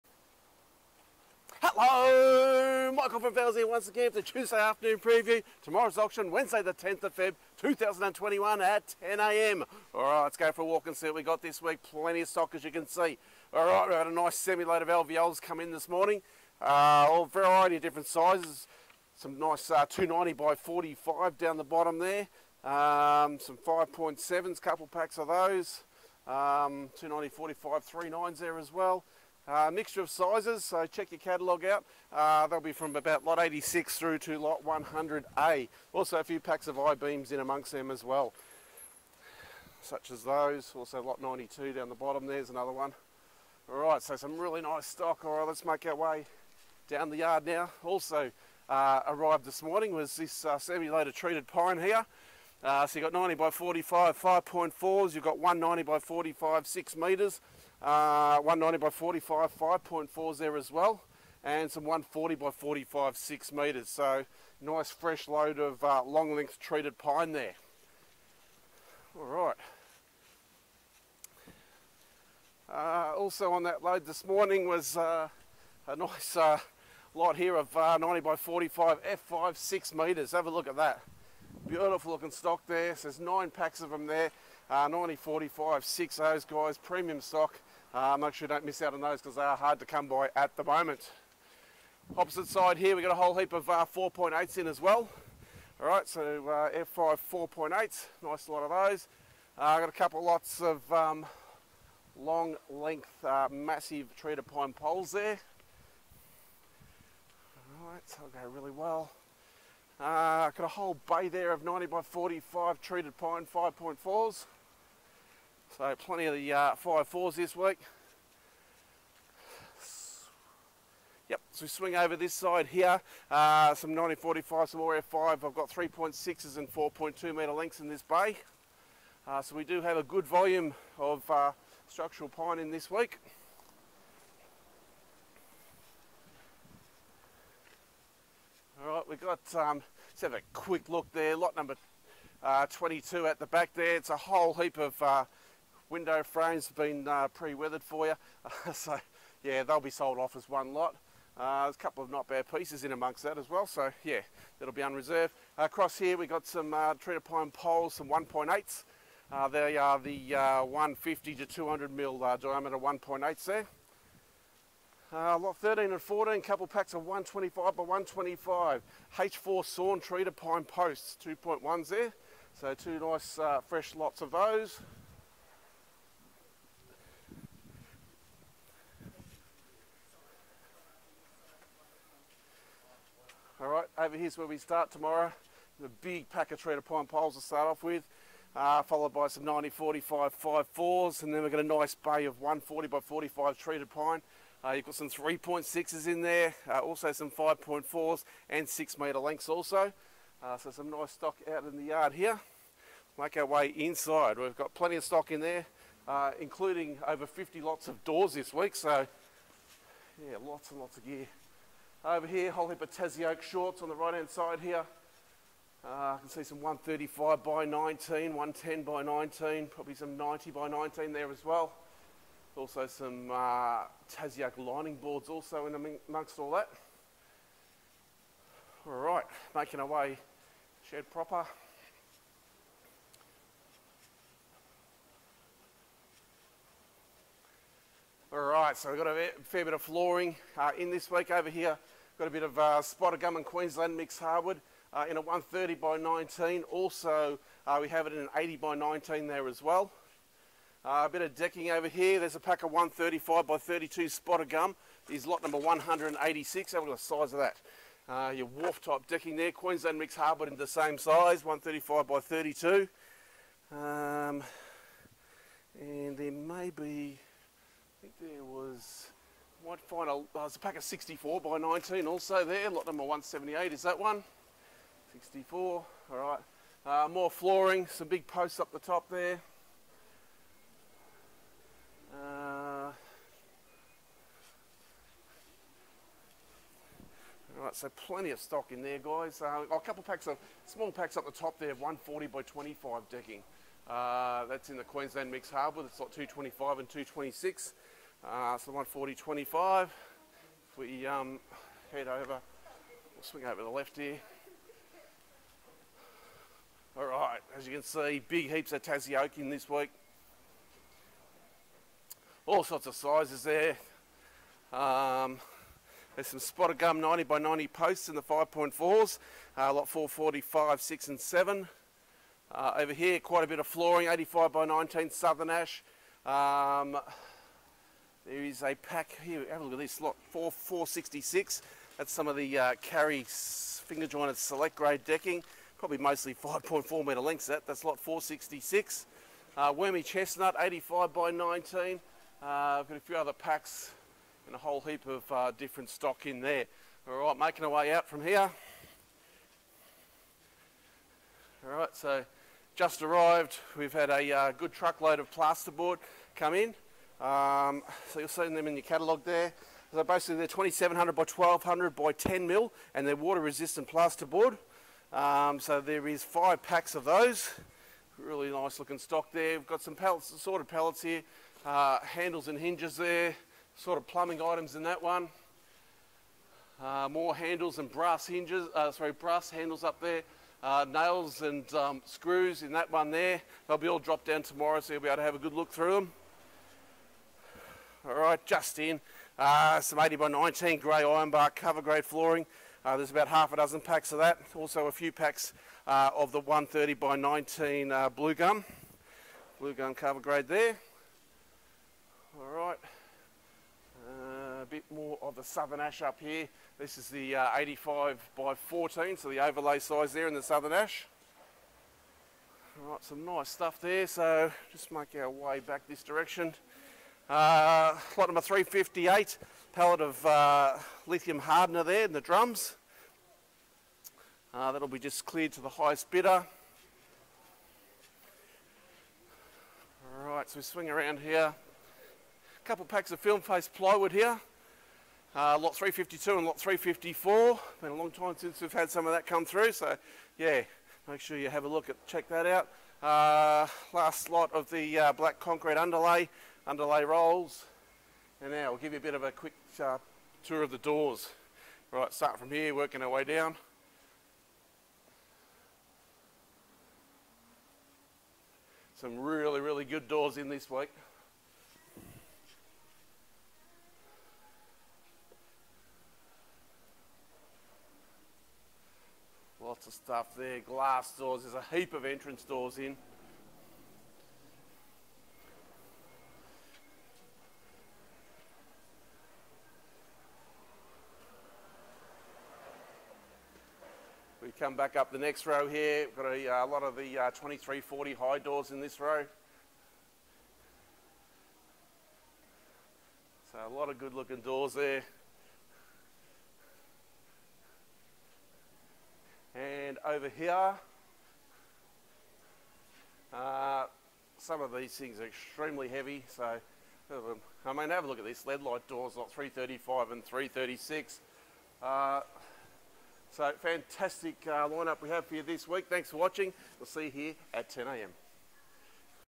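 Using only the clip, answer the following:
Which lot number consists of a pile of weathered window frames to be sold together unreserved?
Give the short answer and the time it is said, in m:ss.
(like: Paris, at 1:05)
22, at 2:22.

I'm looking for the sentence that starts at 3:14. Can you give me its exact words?
Uh, you've got some 3.6s in there, uh, also some 5.4s and 6 metre lengths also.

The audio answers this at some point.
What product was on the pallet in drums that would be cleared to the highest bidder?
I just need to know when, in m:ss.
7:01.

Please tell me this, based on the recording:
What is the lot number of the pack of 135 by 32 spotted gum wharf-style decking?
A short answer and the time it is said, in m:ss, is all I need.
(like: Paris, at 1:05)
186, at 4:15.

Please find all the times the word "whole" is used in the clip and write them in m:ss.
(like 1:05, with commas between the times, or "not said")
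1:33, 1:50, 2:24, 3:32, 5:44.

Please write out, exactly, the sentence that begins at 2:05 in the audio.
I've got 3.6s and 4.2 metre lengths in this bay.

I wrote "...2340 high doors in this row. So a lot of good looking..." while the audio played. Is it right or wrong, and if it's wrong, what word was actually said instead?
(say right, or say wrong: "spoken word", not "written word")
right.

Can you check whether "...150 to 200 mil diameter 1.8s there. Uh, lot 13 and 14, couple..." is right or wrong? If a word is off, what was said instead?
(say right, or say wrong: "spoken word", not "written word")
right.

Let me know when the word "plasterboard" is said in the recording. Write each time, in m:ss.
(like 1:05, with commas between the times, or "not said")
5:55, 6:03.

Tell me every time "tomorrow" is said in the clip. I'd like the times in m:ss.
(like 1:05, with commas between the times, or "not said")
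0:05, 3:04, 6:24.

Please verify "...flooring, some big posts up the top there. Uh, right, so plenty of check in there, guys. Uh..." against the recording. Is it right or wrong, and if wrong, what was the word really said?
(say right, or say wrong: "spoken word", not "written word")
wrong: "stock", not "check".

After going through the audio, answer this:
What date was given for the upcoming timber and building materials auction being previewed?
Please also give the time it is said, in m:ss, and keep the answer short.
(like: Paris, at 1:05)
Wednesday 10 February 2021, at 0:06.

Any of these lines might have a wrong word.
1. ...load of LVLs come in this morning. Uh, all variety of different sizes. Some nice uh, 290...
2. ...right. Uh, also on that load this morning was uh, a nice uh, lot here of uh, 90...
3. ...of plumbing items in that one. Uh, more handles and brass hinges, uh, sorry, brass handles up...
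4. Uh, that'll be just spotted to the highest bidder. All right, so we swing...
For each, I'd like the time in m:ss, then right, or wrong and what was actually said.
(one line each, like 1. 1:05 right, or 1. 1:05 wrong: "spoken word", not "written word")
1. 0:14 right
2. 1:09 right
3. 6:13 right
4. 7:04 wrong: "cleared", not "spotted".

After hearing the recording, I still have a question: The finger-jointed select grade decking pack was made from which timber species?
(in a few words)
Karri.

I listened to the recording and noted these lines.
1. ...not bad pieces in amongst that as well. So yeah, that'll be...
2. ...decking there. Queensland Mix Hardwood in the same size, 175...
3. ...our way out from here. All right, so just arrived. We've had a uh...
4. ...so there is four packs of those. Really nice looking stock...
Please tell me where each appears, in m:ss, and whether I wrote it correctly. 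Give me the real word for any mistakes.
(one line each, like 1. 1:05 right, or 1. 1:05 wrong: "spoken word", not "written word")
1. 2:32 right
2. 4:19 wrong: "135", not "175"
3. 5:47 right
4. 6:05 wrong: "five", not "four".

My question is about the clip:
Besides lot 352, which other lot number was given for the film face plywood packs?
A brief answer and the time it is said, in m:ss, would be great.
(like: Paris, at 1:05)
354, at 7:16.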